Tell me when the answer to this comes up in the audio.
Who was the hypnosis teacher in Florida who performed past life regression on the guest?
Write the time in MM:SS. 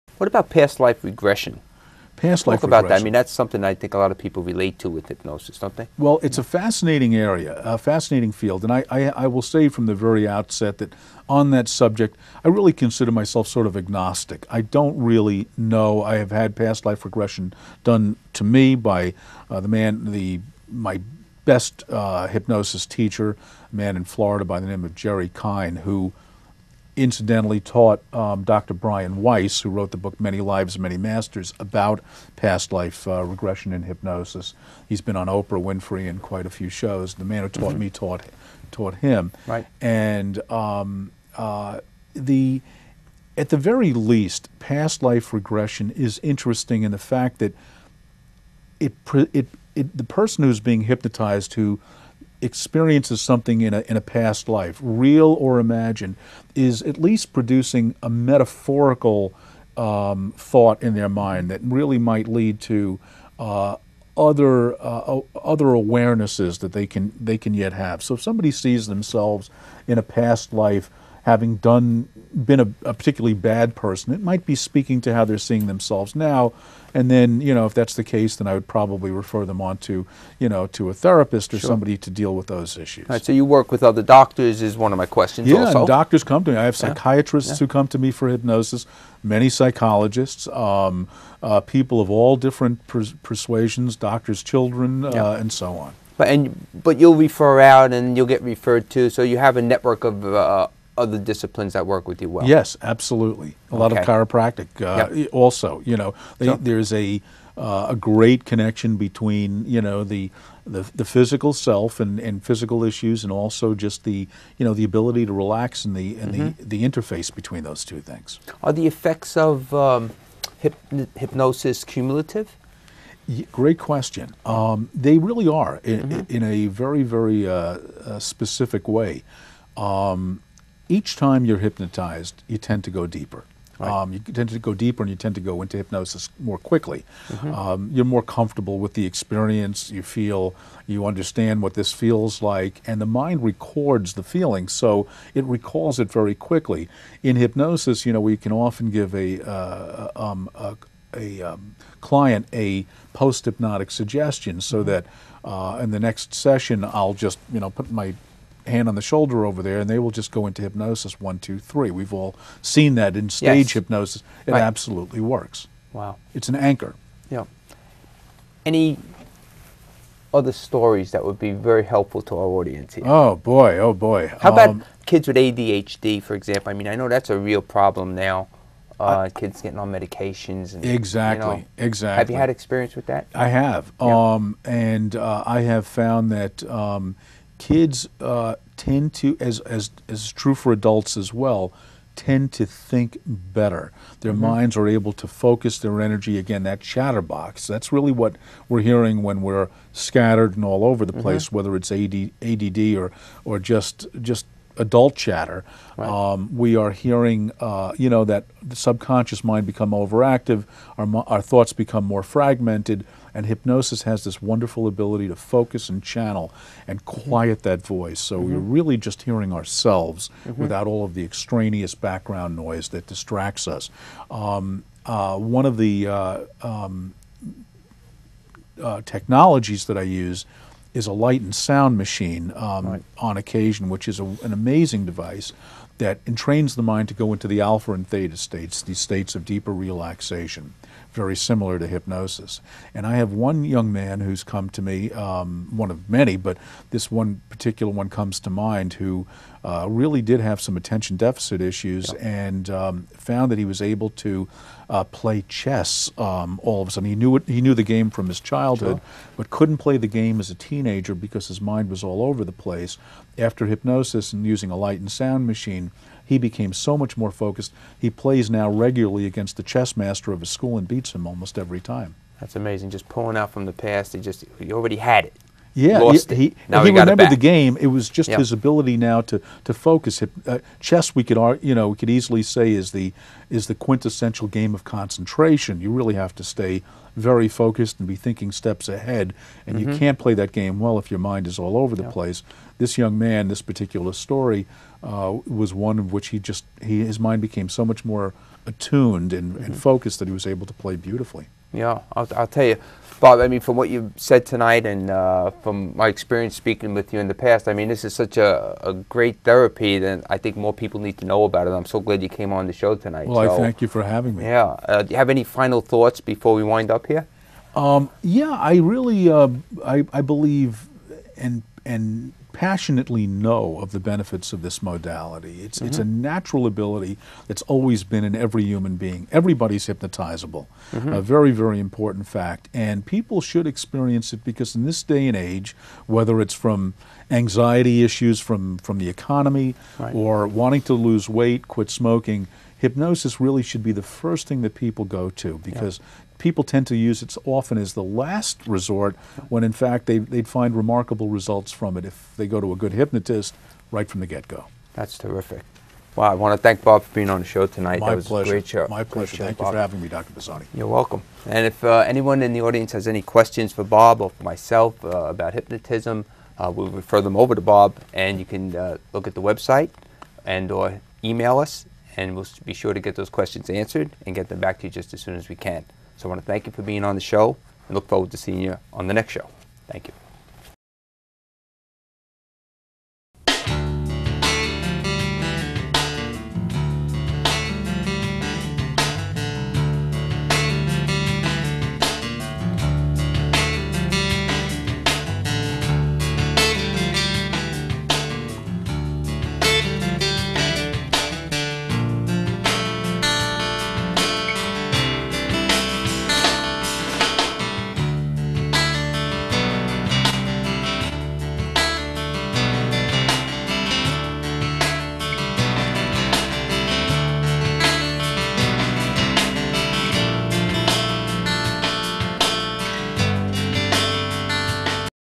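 00:24.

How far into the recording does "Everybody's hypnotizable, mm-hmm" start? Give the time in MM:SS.
05:29.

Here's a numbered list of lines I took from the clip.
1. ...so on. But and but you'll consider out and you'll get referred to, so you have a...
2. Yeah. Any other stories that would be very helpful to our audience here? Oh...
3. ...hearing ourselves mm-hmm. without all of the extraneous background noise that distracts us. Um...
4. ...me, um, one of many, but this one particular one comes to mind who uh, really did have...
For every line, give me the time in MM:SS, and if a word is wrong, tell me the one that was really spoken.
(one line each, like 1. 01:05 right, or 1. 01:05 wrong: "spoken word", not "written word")
1. 01:35 wrong: "refer", not "consider"
2. 02:47 right
3. 03:39 right
4. 04:04 right.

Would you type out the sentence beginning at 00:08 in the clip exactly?
And I, I, I will say from the very outset that on that subject, I really consider myself sort of agnostic.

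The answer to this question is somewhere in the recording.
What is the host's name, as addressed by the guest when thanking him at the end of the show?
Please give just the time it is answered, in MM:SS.
06:00.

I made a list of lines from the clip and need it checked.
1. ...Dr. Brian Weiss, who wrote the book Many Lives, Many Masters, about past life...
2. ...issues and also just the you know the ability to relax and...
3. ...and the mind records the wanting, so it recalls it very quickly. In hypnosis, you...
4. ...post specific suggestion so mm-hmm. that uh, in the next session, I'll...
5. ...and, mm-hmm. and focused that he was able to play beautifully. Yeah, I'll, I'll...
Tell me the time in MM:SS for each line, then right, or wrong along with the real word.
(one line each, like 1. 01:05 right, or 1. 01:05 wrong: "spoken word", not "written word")
1. 00:28 right
2. 01:52 right
3. 02:22 wrong: "feeling", not "wanting"
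4. 02:33 wrong: "hypnotic", not "specific"
5. 04:59 right.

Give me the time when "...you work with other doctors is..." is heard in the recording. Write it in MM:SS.
01:23.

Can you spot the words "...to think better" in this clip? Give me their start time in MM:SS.
03:12.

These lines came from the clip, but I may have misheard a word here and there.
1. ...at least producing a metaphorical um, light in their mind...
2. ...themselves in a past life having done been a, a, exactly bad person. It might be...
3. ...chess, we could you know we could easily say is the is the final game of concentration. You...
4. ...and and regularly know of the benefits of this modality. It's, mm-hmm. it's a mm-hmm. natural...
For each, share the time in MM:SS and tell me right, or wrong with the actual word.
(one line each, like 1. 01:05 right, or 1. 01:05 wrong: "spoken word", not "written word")
1. 00:56 wrong: "thought", not "light"
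2. 01:08 wrong: "particularly", not "exactly"
3. 04:40 wrong: "quintessential", not "final"
4. 05:21 wrong: "passionately", not "regularly".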